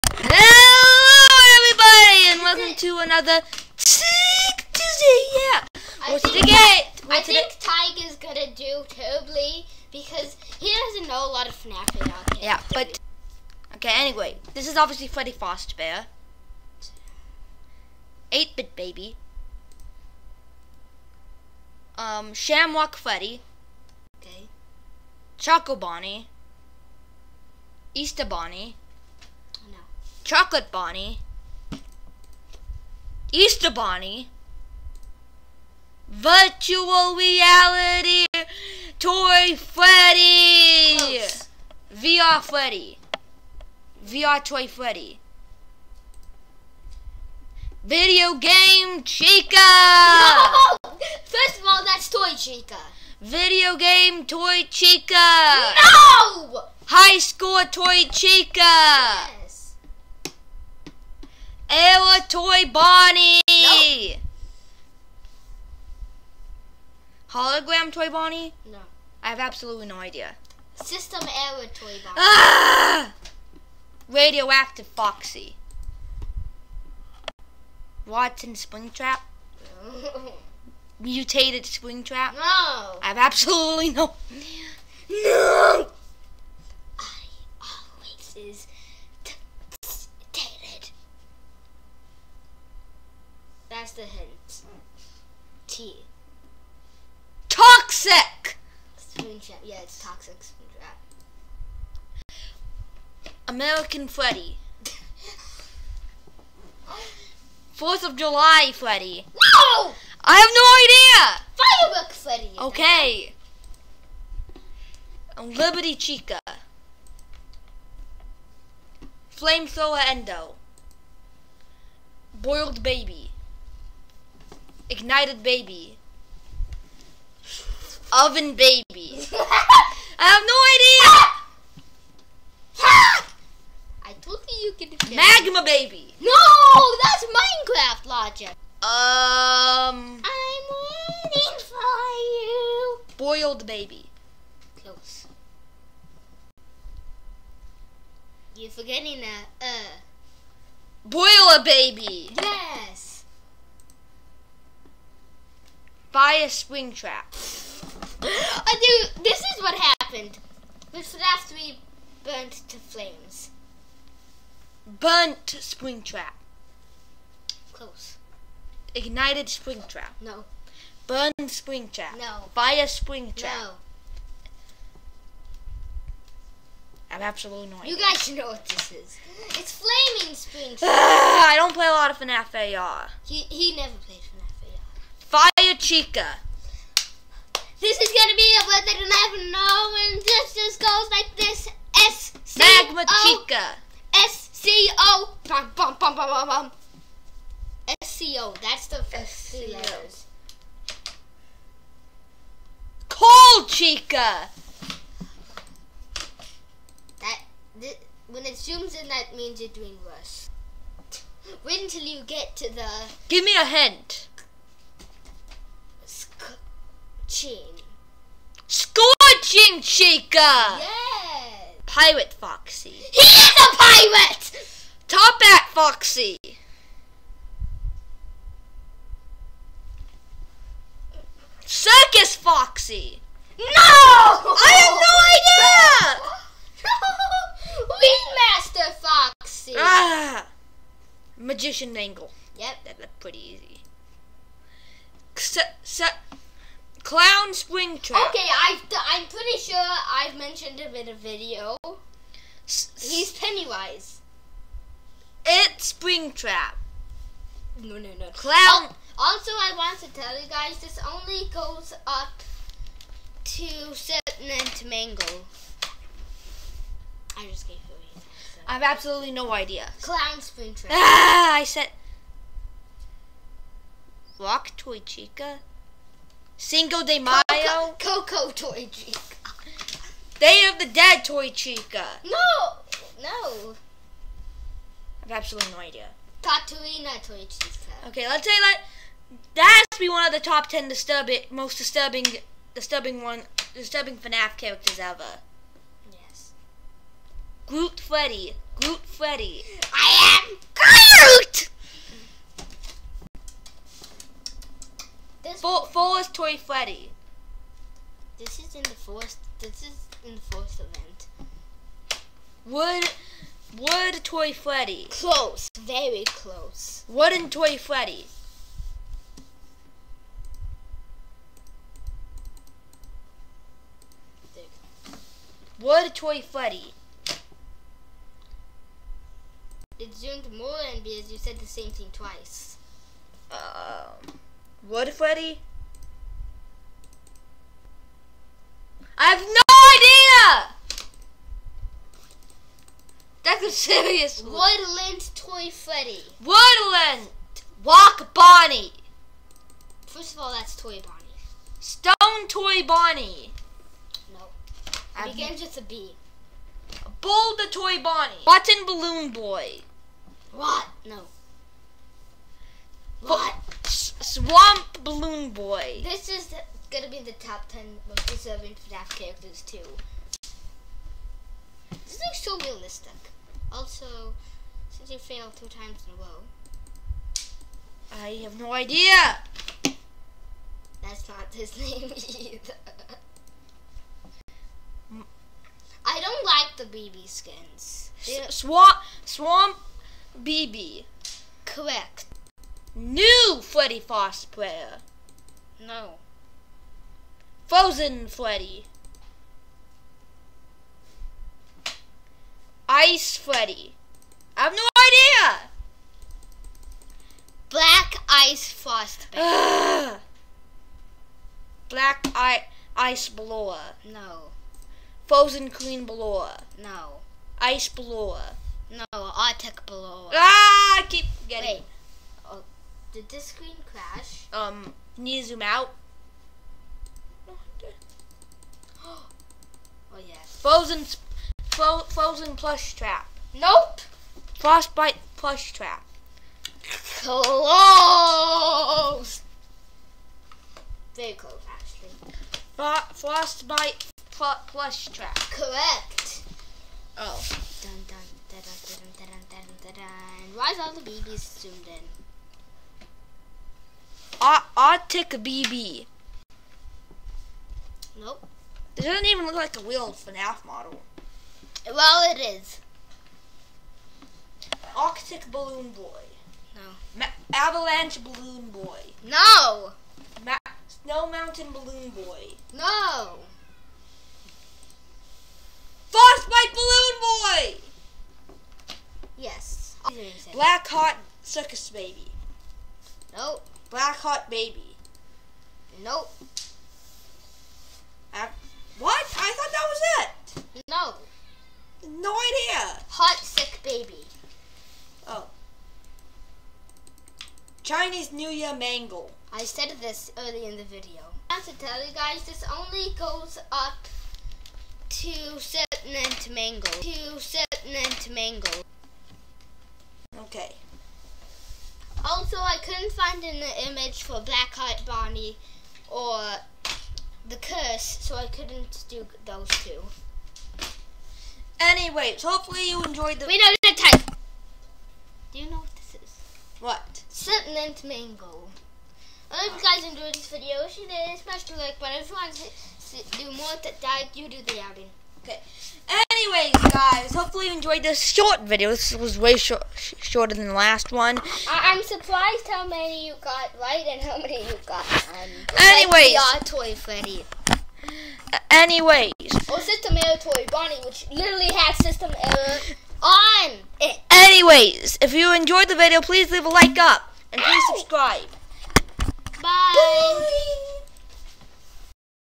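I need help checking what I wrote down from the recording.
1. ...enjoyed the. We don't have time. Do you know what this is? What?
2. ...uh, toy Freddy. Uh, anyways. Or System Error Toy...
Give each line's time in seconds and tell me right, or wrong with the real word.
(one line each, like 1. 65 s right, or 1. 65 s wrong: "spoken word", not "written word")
1. 523 s right
2. 546 s right.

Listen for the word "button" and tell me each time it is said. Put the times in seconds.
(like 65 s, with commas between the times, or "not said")
358 s, 531 s.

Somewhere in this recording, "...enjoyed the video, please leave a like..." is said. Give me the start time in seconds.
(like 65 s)
555 s.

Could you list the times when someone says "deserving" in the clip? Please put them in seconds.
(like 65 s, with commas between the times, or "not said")
368 s.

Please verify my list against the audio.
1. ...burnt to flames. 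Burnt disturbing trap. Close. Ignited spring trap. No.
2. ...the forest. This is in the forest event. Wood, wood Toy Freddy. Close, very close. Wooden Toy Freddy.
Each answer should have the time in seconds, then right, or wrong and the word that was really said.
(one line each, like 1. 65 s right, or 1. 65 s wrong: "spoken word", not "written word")
1. 162 s wrong: "spring", not "disturbing"
2. 308 s right.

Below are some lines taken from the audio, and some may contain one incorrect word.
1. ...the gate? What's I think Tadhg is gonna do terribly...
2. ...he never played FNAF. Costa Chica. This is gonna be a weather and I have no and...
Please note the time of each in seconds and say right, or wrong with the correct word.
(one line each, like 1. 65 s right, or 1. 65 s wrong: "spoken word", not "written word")
1. 6 s right
2. 183 s right.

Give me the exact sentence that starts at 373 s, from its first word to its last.
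Also, since you failed two times in a row.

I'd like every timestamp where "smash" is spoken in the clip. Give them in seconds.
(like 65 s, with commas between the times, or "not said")
531 s.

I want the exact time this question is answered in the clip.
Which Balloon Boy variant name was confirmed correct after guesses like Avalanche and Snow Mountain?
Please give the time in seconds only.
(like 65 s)
476 s.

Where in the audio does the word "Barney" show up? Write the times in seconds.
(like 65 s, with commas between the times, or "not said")
515 s.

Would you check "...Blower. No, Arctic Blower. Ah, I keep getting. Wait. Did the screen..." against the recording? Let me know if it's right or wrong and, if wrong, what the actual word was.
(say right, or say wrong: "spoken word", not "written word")
right.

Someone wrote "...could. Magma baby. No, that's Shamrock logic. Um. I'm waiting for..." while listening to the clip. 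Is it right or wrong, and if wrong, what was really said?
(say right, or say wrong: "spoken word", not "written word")
wrong: "Minecraft", not "Shamrock".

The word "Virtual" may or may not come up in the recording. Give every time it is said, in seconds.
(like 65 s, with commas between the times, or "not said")
36 s.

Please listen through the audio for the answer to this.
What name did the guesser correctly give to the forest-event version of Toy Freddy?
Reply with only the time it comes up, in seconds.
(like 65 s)
344 s.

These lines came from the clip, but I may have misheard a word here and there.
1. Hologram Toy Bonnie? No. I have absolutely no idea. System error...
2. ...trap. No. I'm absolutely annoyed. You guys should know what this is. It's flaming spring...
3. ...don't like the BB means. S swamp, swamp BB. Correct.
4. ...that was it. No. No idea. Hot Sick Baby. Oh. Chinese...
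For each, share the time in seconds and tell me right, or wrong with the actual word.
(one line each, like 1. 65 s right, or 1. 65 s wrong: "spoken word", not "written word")
1. 67 s right
2. 173 s right
3. 386 s wrong: "skins", not "means"
4. 489 s right.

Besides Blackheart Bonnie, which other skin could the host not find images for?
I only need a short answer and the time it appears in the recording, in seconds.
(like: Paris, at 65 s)
The Curse, at 517 s.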